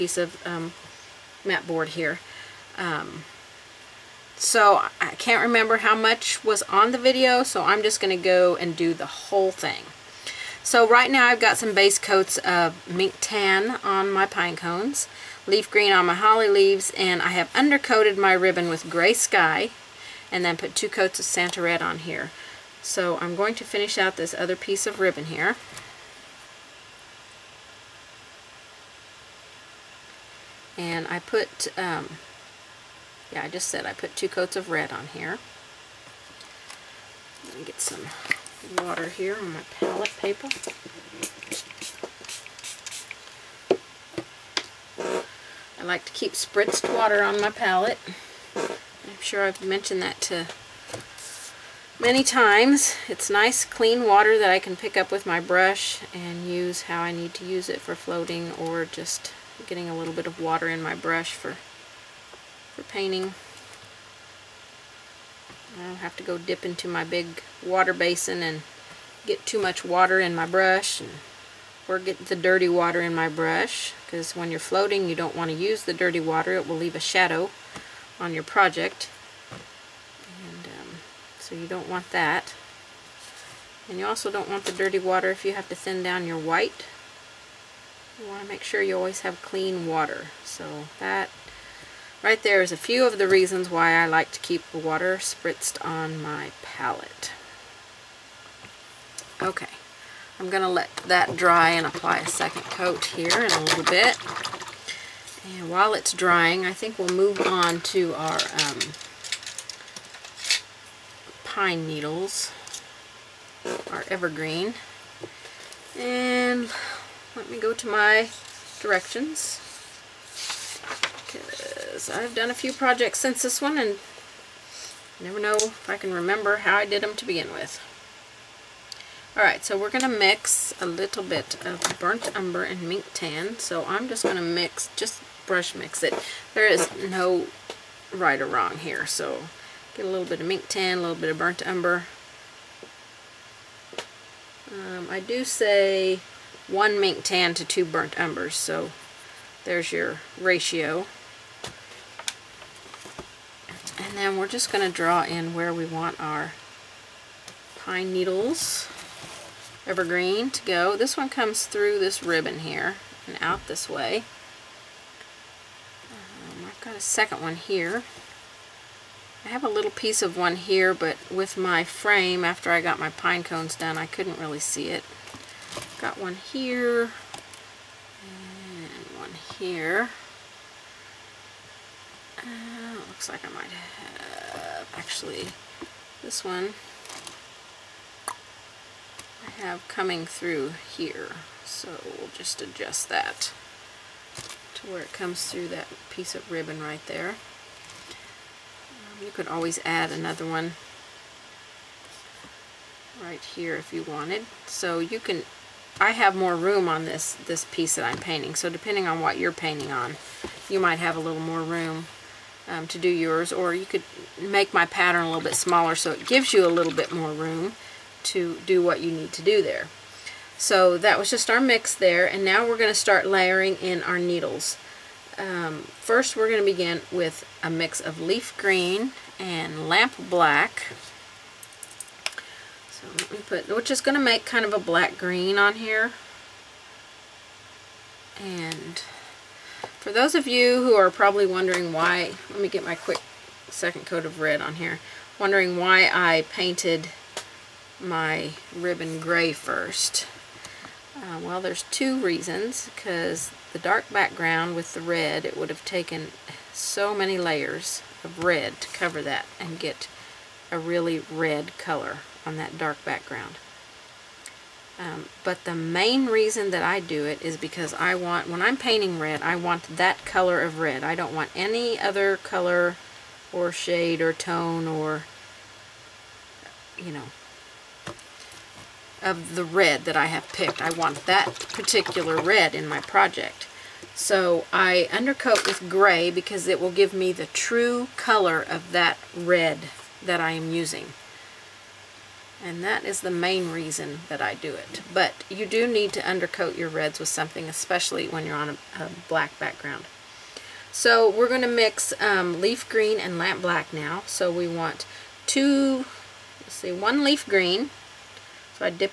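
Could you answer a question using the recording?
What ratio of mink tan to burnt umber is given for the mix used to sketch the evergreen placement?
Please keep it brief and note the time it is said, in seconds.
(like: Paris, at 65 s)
1 to 2, at 146 s.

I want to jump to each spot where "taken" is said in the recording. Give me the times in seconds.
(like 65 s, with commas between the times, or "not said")
255 s.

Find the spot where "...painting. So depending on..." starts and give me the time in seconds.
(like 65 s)
208 s.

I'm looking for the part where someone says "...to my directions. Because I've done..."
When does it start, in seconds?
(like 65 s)
117 s.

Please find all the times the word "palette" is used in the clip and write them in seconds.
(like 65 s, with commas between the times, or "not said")
39 s, 47 s, 96 s.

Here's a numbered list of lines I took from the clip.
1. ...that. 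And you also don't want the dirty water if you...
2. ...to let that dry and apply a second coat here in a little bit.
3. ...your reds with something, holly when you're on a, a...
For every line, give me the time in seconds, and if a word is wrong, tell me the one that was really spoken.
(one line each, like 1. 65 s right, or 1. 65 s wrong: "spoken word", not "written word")
1. 82 s right
2. 100 s right
3. 296 s wrong: "especially", not "holly".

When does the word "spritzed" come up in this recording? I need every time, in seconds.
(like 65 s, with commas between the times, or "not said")
46 s, 95 s.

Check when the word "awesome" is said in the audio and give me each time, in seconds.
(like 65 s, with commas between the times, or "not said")
not said.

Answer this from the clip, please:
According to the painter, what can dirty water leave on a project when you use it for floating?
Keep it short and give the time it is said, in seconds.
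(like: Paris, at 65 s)
A shadow, at 76 s.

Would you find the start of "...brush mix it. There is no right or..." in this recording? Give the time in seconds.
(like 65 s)
135 s.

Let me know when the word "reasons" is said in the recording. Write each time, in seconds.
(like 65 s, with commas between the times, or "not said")
93 s, 252 s, 266 s, 293 s.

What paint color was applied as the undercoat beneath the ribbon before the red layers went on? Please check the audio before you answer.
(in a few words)
Gray sky.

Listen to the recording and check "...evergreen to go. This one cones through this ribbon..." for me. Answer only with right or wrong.
wrong.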